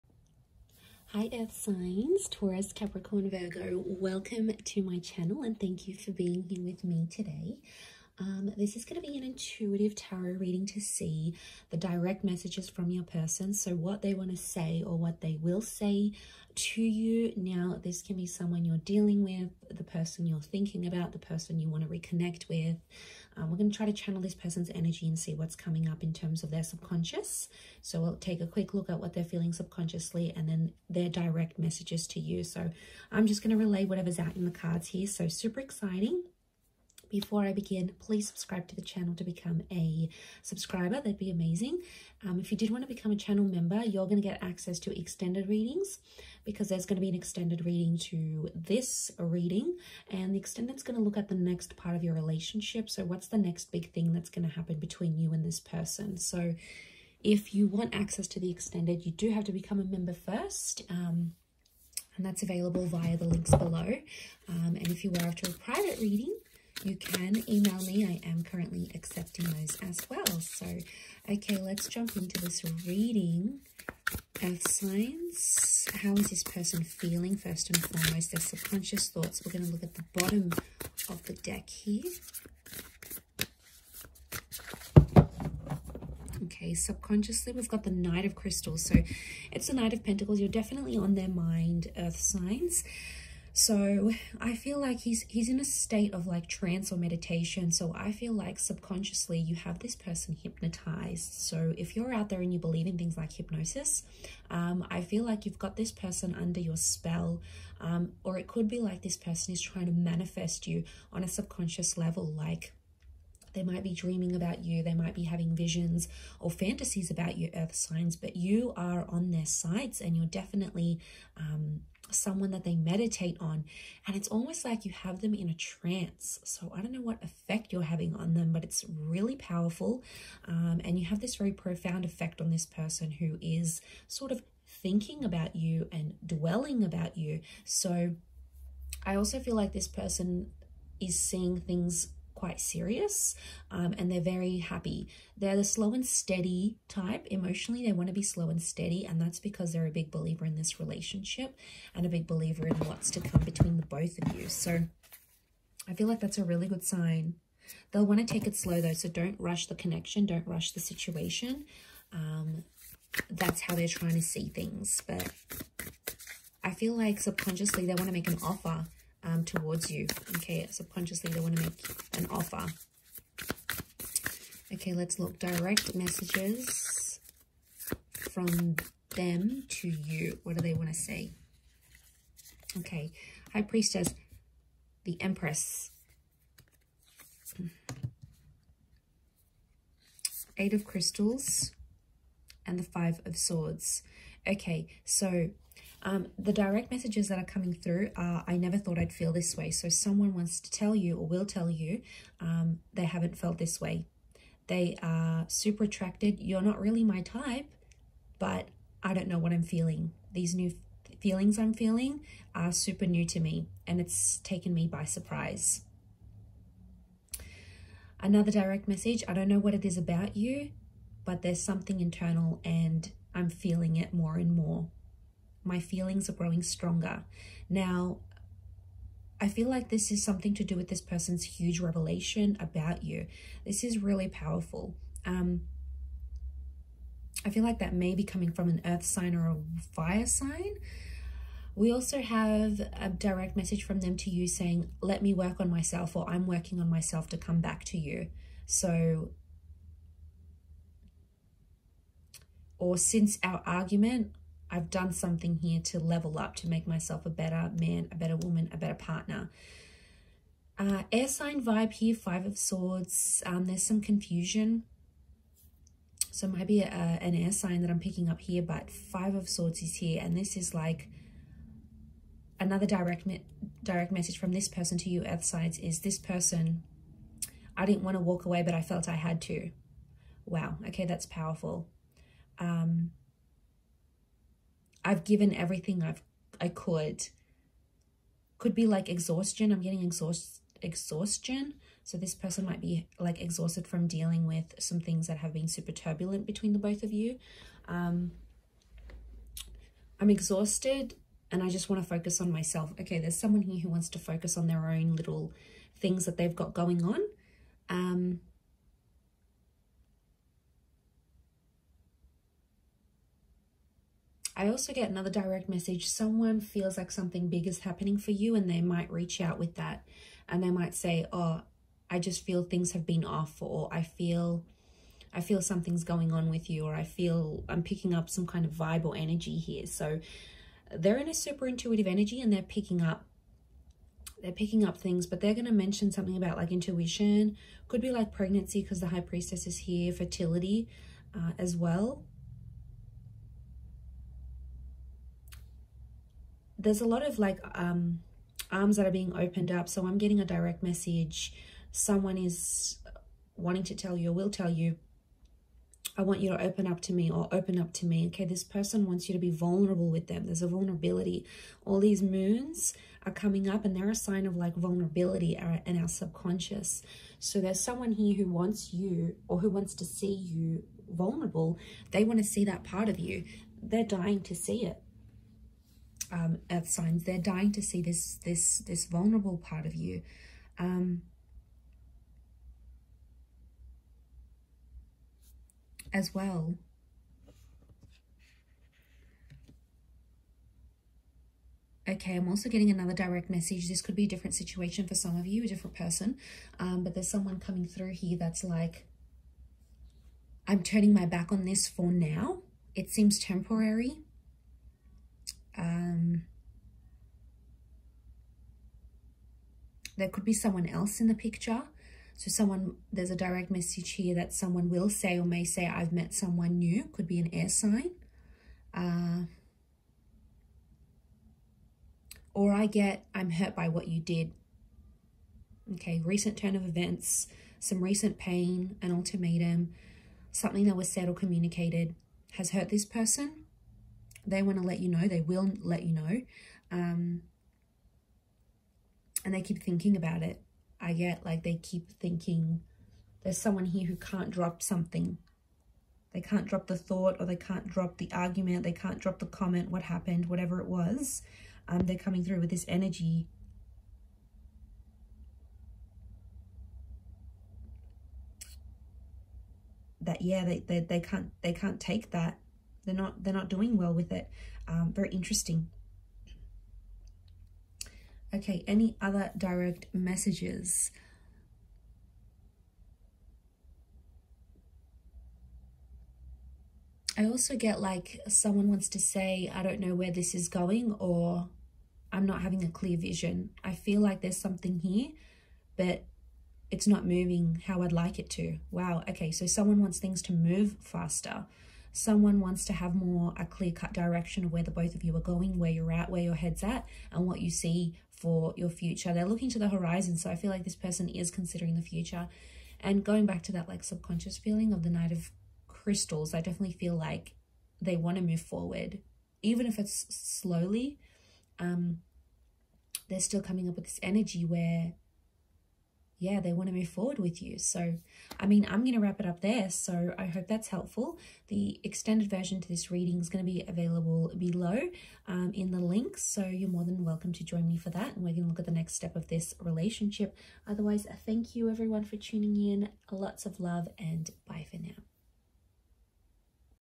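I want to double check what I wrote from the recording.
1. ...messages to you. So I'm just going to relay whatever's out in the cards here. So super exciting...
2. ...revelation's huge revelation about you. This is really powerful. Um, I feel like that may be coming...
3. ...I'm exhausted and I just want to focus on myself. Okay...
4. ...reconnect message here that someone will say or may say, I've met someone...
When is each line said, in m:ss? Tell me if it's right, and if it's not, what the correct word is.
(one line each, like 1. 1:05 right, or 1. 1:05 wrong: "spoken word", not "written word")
1. 0:31 right
2. 3:51 wrong: "person", not "revelation"
3. 5:00 right
4. 6:53 wrong: "direct", not "reconnect".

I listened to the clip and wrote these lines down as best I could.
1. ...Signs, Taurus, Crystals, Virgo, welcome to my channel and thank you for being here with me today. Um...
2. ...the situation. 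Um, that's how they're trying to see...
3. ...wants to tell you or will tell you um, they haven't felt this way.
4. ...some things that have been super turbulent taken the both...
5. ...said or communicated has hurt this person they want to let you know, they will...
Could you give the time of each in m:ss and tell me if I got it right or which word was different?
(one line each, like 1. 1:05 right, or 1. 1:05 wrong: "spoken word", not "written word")
1. 0:01 wrong: "Capricorn", not "Crystals"
2. 2:40 right
3. 3:20 right
4. 4:54 wrong: "between", not "taken"
5. 7:11 right.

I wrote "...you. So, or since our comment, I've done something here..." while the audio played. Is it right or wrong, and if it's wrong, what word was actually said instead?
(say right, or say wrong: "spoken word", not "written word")
wrong: "argument", not "comment".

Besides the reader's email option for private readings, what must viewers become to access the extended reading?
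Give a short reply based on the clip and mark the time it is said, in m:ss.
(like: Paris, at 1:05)
A channel member, at 0:59.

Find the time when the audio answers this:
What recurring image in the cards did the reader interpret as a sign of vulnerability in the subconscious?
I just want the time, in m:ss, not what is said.
6:02.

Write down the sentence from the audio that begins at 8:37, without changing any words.
So, I mean, I'm going to wrap it up there.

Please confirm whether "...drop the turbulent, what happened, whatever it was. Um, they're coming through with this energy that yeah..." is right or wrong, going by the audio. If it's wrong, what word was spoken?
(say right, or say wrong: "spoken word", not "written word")
wrong: "comment", not "turbulent".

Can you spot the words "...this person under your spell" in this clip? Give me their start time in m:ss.
1:45.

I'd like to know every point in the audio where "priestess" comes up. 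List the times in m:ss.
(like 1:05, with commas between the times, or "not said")
3:03, 5:39.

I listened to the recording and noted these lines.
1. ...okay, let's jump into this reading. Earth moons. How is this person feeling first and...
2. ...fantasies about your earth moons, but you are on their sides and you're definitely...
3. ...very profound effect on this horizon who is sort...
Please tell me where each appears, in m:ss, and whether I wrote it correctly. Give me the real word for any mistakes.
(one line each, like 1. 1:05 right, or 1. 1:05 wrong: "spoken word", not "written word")
1. 1:11 wrong: "signs", not "moons"
2. 1:56 wrong: "signs", not "moons"
3. 2:11 wrong: "person", not "horizon".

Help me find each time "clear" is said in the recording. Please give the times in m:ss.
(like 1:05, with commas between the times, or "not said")
8:02, 8:13.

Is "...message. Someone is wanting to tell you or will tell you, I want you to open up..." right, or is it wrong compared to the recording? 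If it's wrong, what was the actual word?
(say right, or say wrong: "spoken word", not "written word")
right.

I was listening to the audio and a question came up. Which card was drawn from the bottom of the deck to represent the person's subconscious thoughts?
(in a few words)
Knight of Pentacles.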